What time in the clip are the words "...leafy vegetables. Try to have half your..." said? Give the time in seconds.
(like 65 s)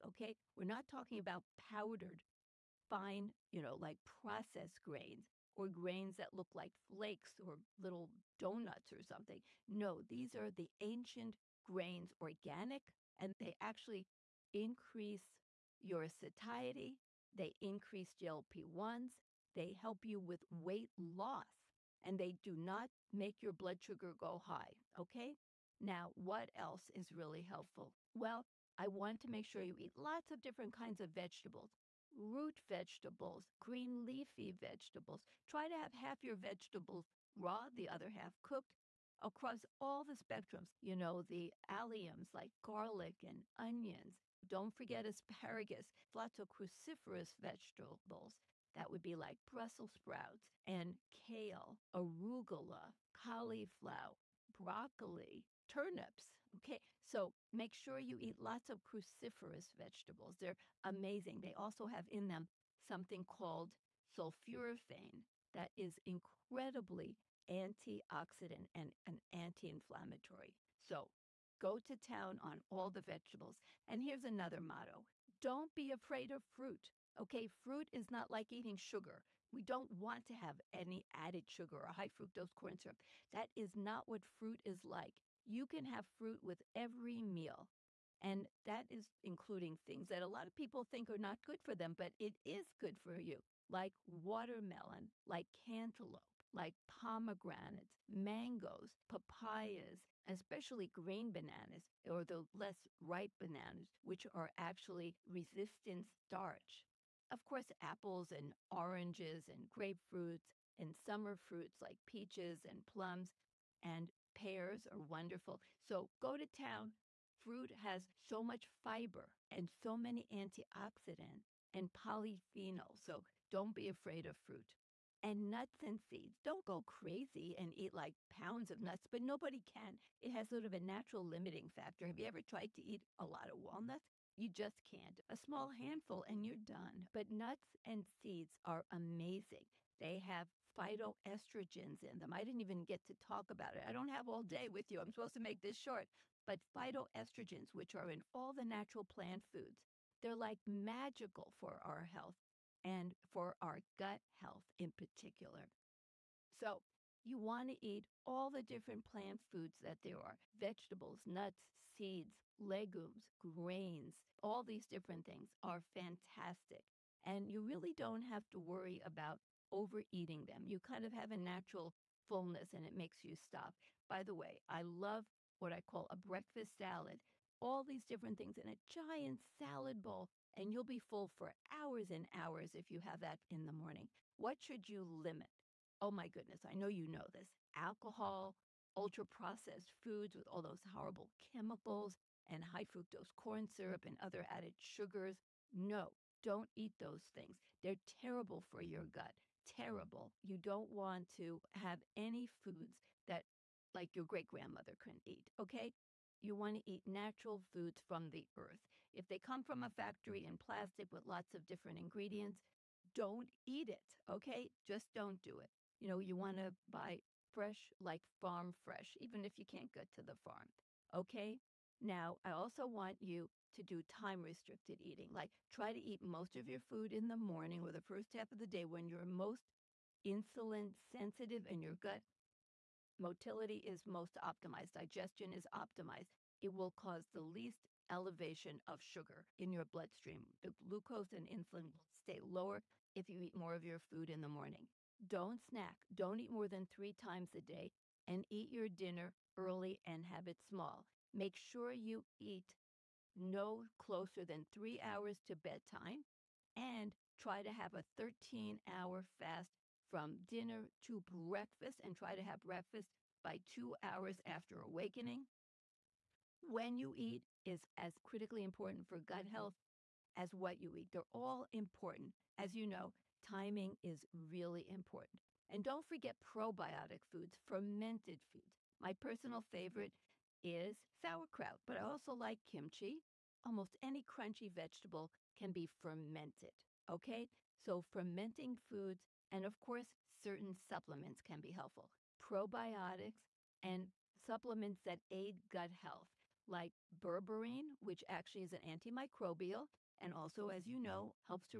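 34 s.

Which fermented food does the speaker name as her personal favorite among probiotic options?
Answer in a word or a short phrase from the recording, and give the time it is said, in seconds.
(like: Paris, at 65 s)
sauerkraut, at 281 s.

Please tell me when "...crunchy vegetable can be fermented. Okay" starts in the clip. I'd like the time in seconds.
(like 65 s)
284 s.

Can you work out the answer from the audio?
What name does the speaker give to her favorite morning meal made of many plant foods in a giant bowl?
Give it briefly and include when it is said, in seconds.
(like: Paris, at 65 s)
breakfast salad, at 176 s.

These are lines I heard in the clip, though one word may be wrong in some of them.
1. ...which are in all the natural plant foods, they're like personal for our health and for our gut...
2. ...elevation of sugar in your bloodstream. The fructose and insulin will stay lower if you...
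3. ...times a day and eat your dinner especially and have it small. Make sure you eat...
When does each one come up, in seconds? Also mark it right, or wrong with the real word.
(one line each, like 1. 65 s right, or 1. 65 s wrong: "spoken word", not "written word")
1. 147 s wrong: "magical", not "personal"
2. 238 s wrong: "glucose", not "fructose"
3. 247 s wrong: "early", not "especially".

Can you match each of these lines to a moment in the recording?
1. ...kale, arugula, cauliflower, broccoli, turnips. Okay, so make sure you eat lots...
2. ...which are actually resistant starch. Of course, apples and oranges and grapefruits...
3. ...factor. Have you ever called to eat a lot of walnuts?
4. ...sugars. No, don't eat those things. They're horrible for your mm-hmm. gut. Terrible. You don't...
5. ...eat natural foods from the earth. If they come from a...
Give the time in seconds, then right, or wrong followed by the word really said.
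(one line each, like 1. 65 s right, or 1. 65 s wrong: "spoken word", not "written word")
1. 51 s right
2. 104 s right
3. 131 s wrong: "tried", not "called"
4. 194 s wrong: "terrible", not "horrible"
5. 206 s right.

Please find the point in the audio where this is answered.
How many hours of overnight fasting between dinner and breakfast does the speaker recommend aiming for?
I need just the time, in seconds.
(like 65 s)
258 s.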